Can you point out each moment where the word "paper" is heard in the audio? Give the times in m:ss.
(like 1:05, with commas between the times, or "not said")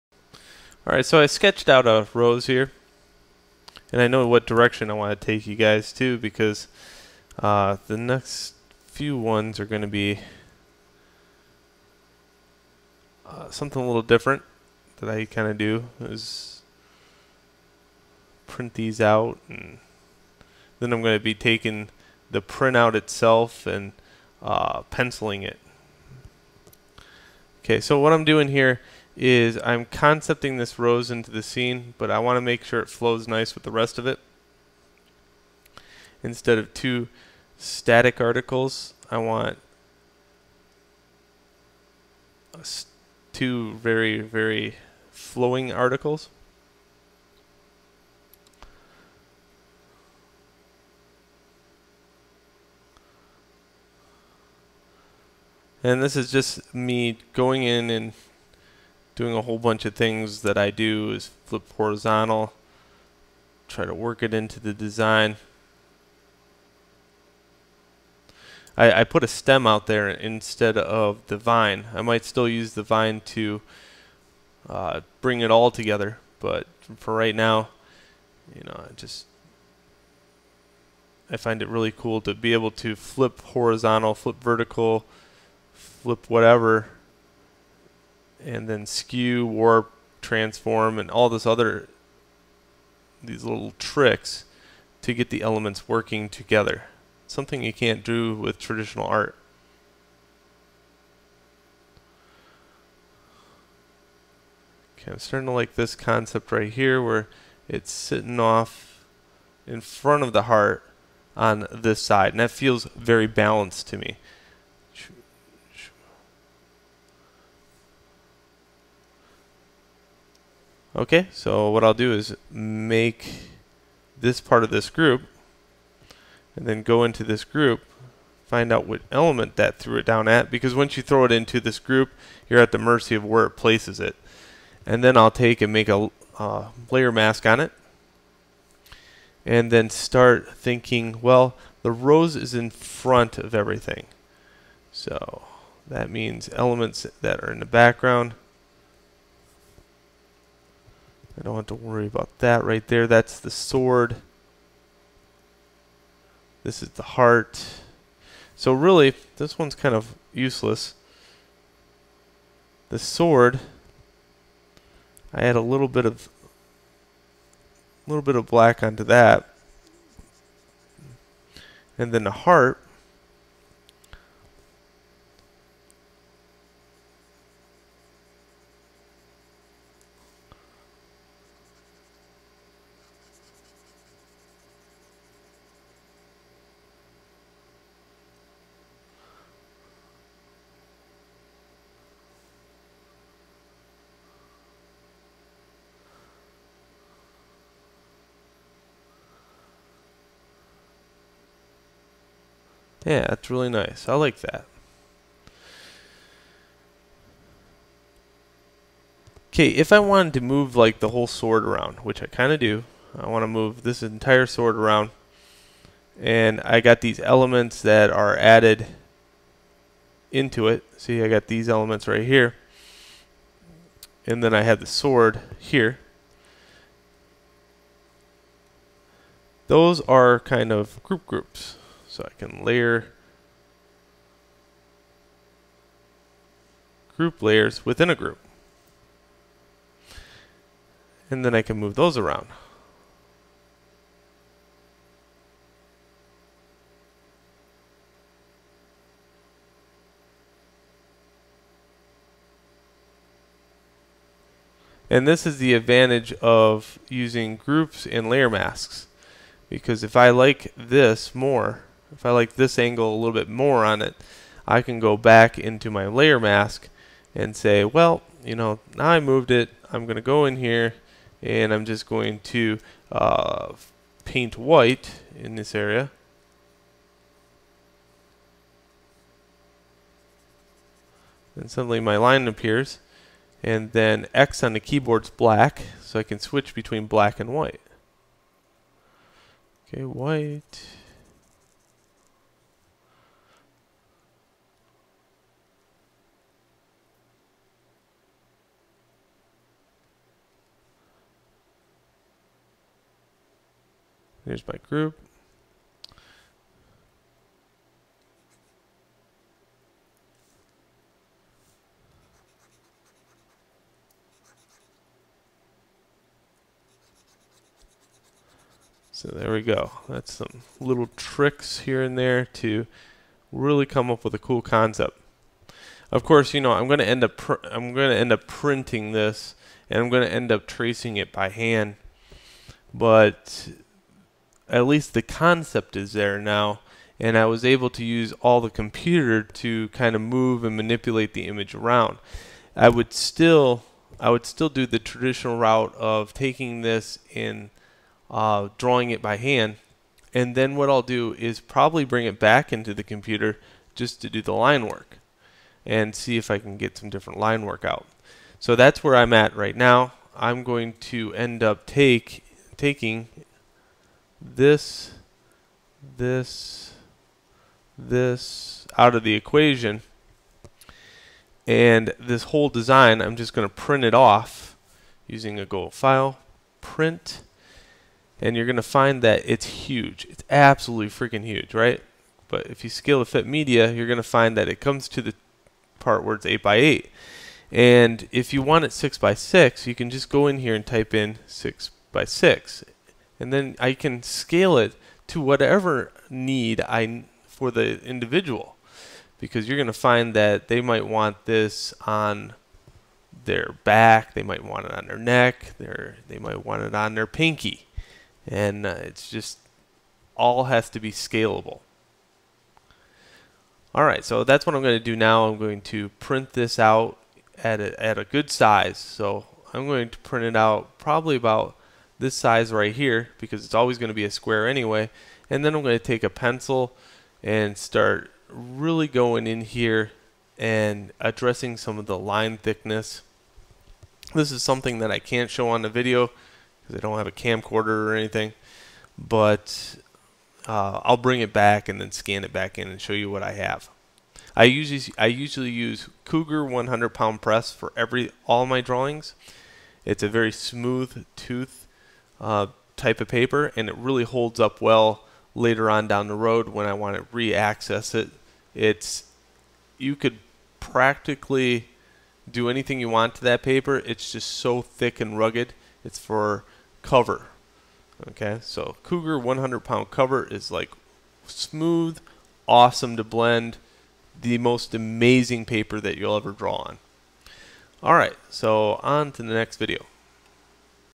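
7:33, 7:43, 7:55.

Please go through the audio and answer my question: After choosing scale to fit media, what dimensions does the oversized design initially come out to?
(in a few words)
8 by 8.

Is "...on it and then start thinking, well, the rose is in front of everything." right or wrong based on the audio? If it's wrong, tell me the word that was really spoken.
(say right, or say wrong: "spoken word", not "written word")
right.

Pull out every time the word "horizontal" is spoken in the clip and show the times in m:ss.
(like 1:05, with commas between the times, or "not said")
1:01, 1:23.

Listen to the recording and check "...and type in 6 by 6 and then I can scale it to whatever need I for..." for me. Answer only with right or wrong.
right.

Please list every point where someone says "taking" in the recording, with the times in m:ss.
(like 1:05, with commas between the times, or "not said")
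0:21, 5:46, 6:02.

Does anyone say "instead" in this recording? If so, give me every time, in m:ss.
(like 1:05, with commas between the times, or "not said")
0:36, 1:10.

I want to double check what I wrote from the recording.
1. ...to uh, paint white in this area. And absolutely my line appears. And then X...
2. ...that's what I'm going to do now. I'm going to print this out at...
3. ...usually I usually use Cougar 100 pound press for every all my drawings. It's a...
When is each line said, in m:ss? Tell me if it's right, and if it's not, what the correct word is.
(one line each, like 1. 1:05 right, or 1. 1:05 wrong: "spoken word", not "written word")
1. 4:32 wrong: "suddenly", not "absolutely"
2. 6:54 right
3. 7:24 right.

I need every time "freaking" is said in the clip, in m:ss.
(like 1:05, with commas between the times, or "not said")
6:21.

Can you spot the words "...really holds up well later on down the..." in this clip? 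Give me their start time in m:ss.
7:33.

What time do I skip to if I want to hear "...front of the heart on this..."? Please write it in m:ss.
1:49.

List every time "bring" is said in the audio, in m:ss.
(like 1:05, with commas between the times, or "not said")
1:15, 5:52, 7:21.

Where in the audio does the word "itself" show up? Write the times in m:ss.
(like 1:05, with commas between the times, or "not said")
0:22.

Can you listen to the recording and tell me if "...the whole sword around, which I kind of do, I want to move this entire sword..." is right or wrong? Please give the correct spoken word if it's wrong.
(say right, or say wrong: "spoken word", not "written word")
right.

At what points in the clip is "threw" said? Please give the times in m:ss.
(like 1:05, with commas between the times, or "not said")
2:09.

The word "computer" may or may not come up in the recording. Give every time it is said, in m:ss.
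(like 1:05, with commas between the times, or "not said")
5:38, 5:53.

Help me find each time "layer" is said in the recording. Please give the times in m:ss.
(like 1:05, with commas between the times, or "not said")
2:16, 3:52, 3:57, 4:18, 4:26.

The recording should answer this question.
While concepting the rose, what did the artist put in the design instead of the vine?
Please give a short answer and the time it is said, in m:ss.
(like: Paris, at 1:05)
A stem, at 1:09.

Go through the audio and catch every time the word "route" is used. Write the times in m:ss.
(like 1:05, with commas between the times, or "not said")
5:45.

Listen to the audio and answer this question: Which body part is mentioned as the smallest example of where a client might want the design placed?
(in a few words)
Pinky.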